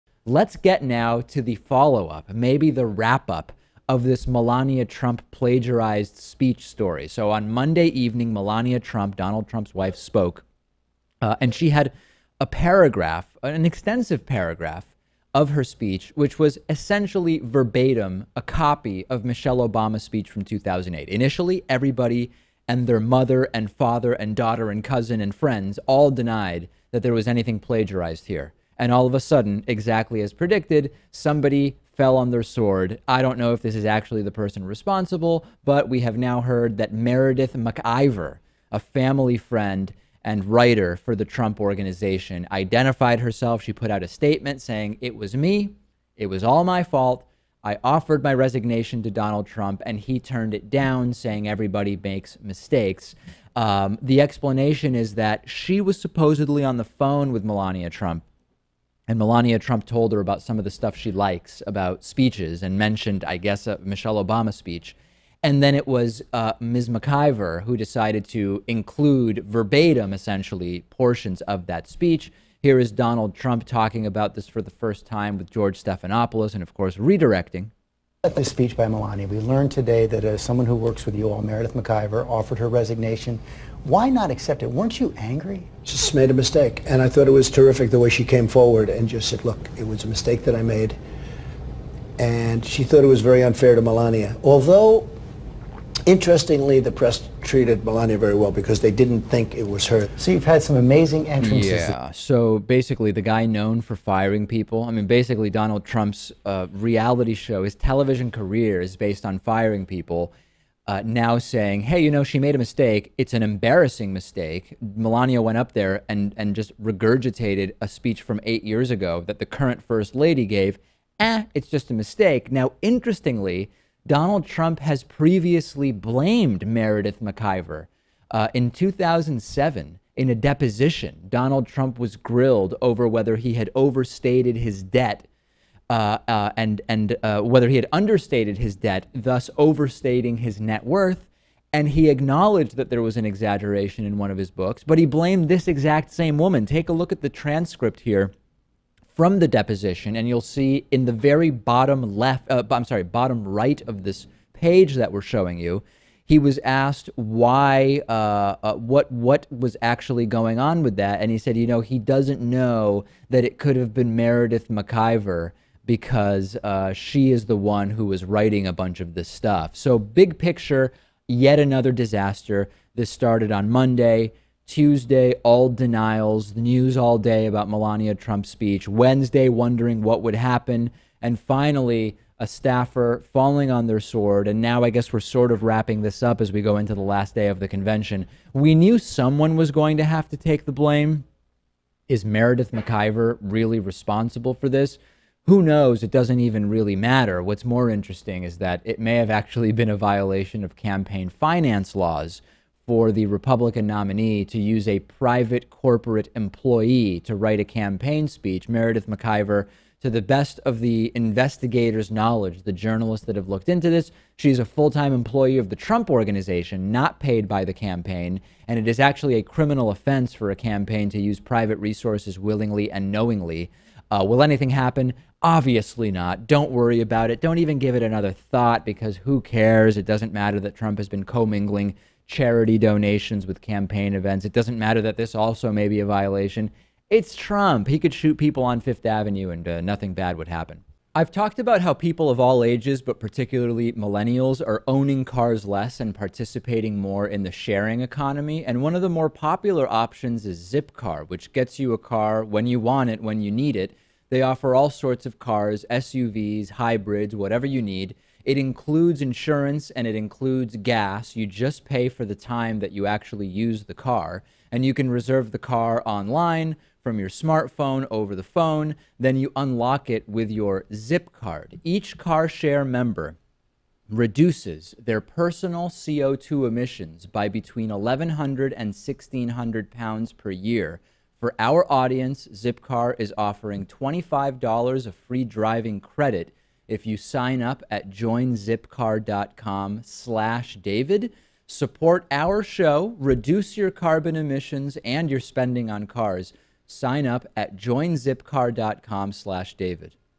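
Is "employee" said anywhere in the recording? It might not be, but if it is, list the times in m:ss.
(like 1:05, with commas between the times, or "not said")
3:26, 3:35.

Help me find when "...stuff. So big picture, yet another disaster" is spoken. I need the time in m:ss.
2:49.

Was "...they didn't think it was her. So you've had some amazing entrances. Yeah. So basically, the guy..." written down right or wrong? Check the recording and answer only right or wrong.
right.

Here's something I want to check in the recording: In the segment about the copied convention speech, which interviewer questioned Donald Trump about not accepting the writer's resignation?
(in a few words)
George Stephanopoulos.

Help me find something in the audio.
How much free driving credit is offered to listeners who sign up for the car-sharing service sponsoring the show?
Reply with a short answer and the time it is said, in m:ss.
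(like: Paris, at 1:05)
$25, at 4:43.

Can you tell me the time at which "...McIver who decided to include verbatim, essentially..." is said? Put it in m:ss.
1:06.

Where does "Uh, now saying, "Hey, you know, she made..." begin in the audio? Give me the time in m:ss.
1:50.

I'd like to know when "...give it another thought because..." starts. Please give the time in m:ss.
3:47.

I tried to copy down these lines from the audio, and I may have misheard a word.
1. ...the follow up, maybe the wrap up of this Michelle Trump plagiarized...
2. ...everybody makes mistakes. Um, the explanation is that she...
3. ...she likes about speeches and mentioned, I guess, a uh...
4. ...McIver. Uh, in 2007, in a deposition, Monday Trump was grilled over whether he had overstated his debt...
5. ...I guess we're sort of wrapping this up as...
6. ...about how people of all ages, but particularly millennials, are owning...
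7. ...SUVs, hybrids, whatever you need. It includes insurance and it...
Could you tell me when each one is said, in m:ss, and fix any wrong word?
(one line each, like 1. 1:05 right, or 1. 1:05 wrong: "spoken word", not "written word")
1. 0:01 wrong: "Melania", not "Michelle"
2. 0:51 right
3. 1:00 right
4. 2:07 wrong: "Donald", not "Monday"
5. 3:04 right
6. 4:01 right
7. 4:15 right.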